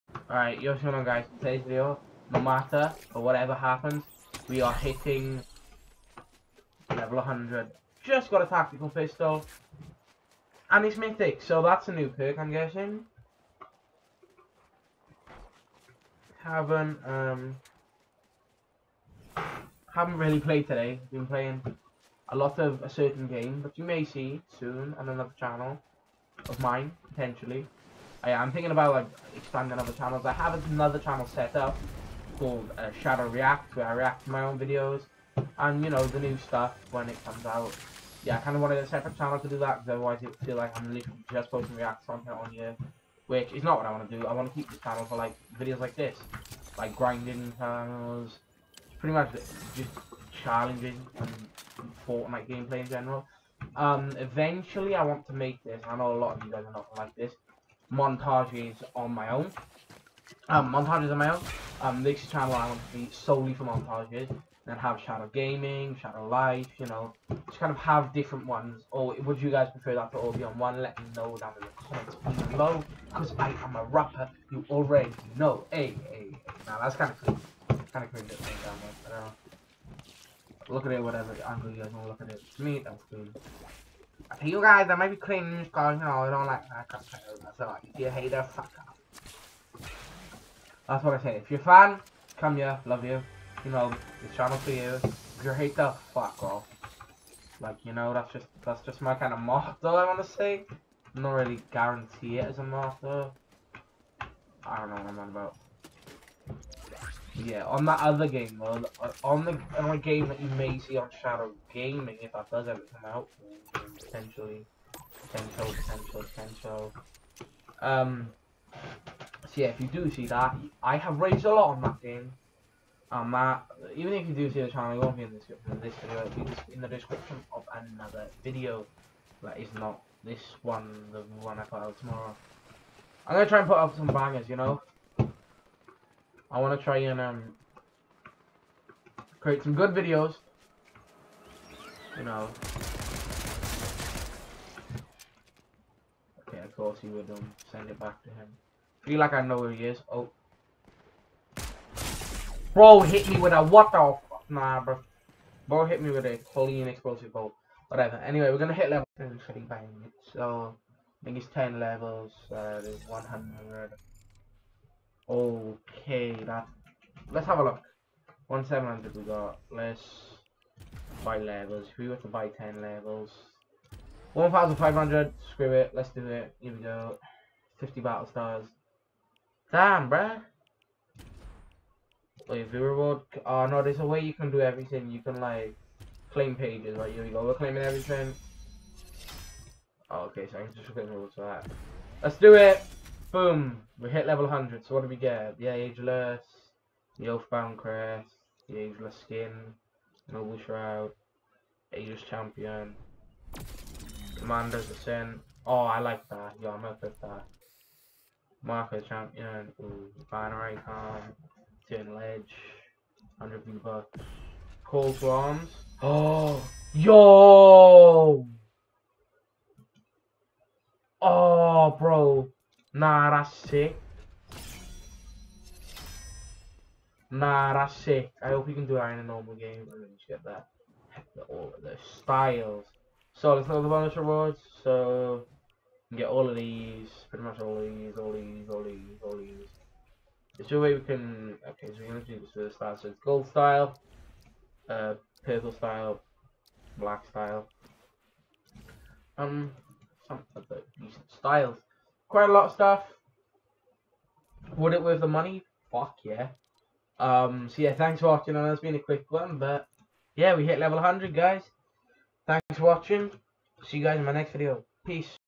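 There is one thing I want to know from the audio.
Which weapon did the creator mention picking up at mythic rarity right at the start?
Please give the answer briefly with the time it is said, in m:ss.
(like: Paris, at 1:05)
Tactical pistol, at 0:08.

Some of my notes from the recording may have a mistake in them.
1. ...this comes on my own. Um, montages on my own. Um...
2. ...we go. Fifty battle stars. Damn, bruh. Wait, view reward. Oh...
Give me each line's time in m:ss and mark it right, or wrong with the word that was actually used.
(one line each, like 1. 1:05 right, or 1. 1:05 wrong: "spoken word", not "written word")
1. 0:57 wrong: "montages", not "comes"
2. 2:56 right.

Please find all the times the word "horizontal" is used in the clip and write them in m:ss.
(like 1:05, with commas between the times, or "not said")
not said.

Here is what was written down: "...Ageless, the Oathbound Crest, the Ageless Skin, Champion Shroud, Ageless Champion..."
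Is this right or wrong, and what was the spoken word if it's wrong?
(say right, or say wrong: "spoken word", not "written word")
wrong: "Noble", not "Champion".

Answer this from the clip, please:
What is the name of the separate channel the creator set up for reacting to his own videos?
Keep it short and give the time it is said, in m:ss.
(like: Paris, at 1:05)
Shadow React, at 0:33.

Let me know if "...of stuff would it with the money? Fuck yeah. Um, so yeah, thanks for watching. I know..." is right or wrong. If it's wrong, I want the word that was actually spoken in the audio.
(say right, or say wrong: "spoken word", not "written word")
right.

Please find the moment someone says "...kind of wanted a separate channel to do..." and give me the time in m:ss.
0:38.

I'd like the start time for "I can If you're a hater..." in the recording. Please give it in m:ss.
1:26.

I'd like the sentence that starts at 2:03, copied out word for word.
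Um, that uh, even if you do see the channel, it won't be in the description of this video.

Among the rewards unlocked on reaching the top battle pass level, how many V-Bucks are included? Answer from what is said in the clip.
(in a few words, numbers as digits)
100.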